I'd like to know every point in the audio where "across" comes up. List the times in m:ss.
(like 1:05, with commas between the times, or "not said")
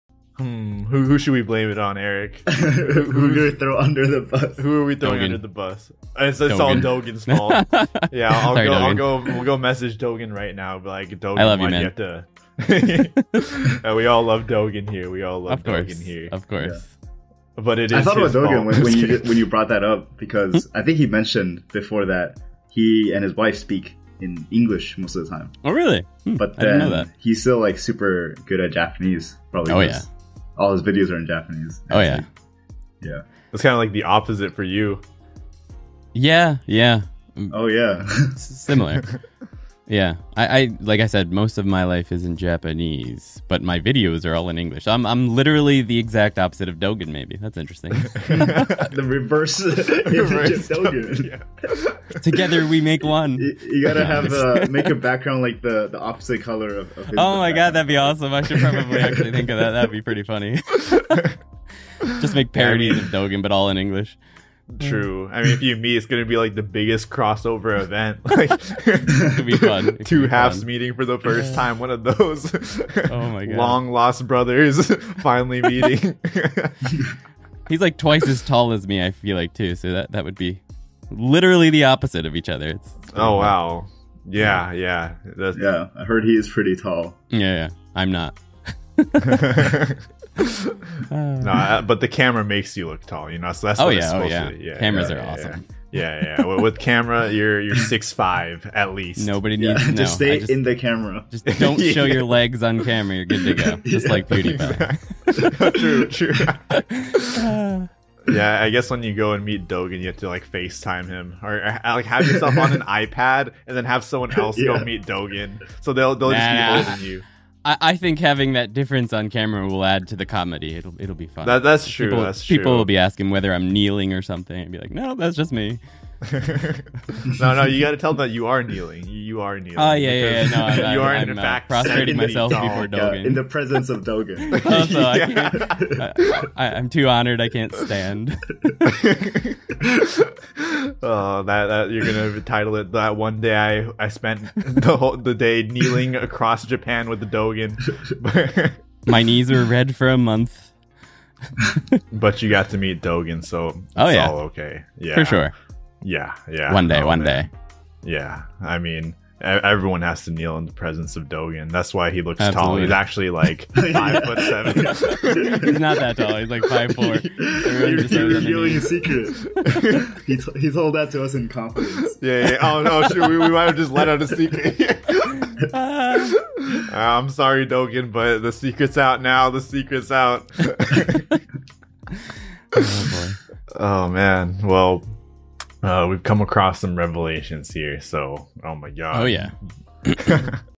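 2:26, 3:06.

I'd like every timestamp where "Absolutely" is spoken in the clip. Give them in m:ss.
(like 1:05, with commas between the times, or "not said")
2:42.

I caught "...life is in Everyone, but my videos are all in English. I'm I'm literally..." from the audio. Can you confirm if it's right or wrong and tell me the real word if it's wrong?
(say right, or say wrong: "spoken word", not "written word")
wrong: "Japanese", not "Everyone".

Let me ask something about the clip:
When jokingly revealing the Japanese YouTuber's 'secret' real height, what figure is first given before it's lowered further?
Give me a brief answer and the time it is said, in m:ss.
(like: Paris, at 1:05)
5'7", at 2:43.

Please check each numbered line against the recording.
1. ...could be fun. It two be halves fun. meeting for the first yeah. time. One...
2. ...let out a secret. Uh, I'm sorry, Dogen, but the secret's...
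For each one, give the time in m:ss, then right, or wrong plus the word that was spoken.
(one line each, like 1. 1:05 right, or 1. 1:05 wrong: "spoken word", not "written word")
1. 1:09 right
2. 2:53 right.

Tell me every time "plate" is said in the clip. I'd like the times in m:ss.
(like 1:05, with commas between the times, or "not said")
not said.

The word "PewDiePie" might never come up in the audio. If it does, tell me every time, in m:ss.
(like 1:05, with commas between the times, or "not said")
1:44.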